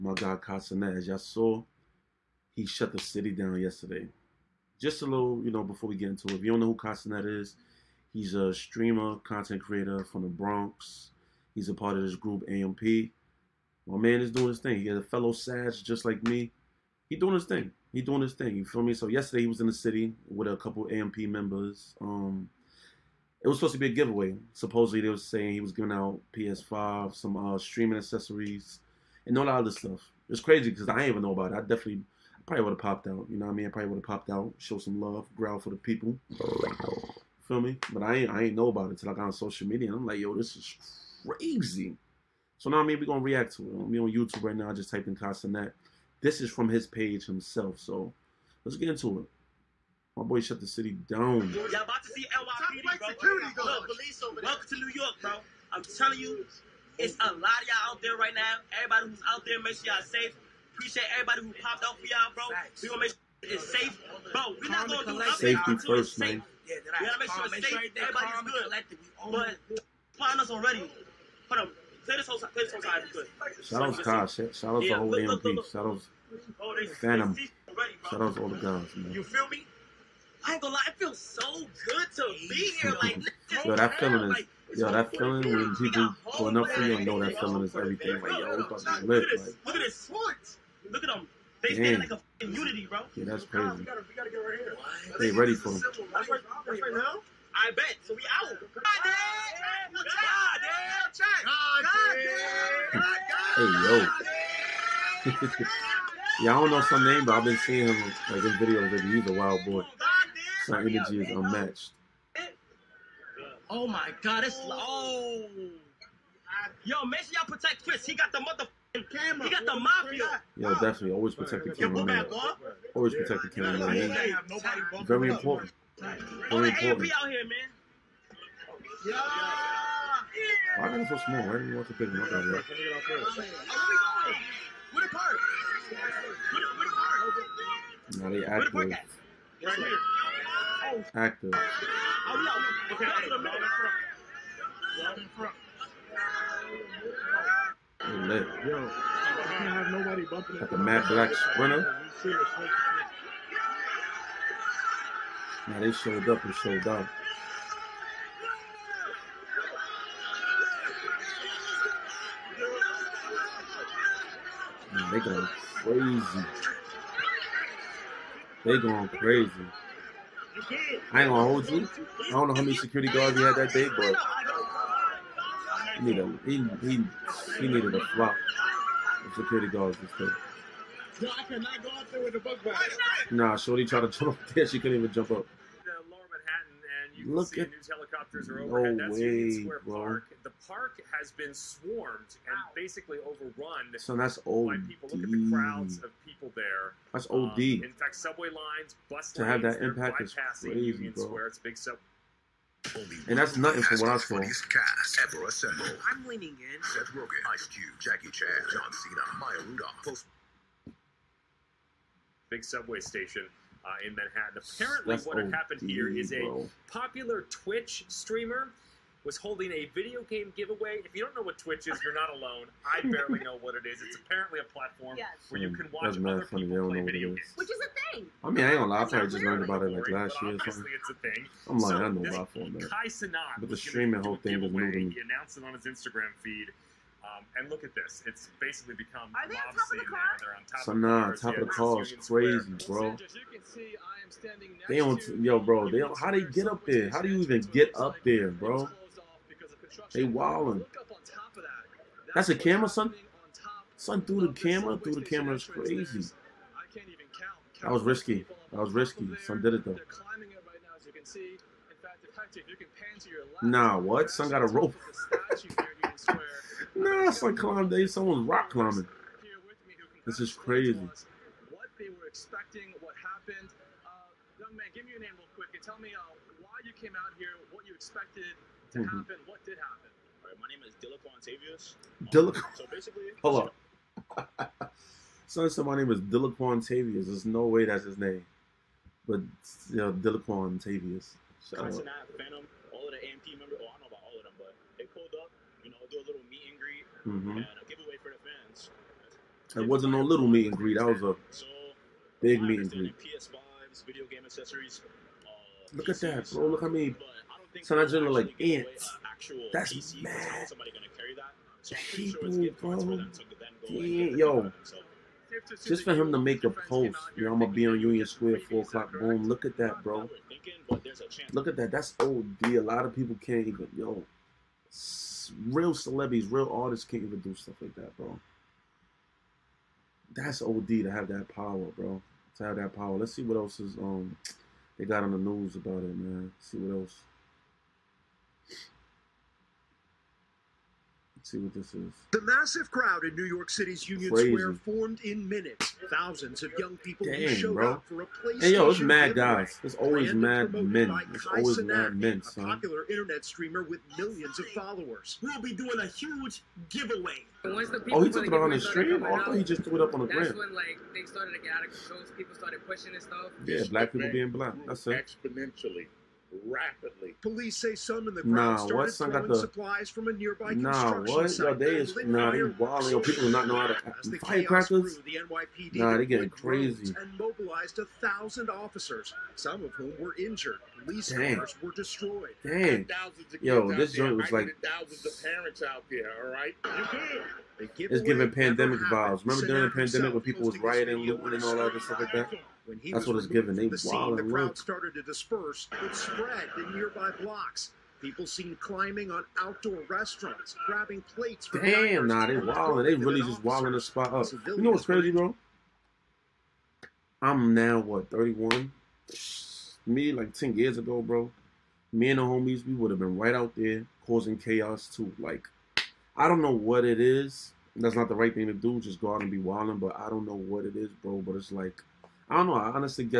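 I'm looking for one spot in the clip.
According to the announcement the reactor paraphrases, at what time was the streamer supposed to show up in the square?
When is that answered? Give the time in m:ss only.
5:18.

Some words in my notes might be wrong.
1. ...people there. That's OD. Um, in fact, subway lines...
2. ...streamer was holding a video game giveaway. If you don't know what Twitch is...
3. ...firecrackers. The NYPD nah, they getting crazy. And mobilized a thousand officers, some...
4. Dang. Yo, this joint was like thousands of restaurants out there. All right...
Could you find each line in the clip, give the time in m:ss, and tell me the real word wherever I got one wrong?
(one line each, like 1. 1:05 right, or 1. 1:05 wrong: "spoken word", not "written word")
1. 3:16 right
2. 3:38 right
3. 6:14 right
4. 6:22 wrong: "parents", not "restaurants".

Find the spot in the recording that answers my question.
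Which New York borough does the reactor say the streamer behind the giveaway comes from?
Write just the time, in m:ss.
0:10.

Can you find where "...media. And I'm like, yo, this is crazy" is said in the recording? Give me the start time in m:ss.
0:39.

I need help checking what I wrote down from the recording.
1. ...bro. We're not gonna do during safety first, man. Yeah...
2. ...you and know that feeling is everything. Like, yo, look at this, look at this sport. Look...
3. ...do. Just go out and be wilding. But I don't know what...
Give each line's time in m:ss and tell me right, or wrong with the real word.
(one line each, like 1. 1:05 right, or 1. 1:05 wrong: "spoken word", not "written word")
1. 1:04 wrong: "nothing", not "during"
2. 1:26 right
3. 6:58 right.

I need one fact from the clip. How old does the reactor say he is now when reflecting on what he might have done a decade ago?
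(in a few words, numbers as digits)
31.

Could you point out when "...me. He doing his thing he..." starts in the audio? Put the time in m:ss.
0:16.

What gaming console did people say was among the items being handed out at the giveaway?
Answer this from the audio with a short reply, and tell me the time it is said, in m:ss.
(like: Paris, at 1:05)
PS5, at 0:26.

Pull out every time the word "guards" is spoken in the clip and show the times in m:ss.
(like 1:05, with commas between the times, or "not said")
2:53, 2:59.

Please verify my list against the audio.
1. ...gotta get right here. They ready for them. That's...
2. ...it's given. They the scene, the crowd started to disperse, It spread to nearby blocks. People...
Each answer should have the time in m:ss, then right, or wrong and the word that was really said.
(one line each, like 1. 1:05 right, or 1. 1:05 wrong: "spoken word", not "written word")
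1. 1:34 right
2. 6:33 right.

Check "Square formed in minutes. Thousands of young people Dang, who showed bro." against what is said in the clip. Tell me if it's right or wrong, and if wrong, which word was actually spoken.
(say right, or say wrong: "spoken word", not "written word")
right.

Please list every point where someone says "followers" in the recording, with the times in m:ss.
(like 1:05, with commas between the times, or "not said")
5:54.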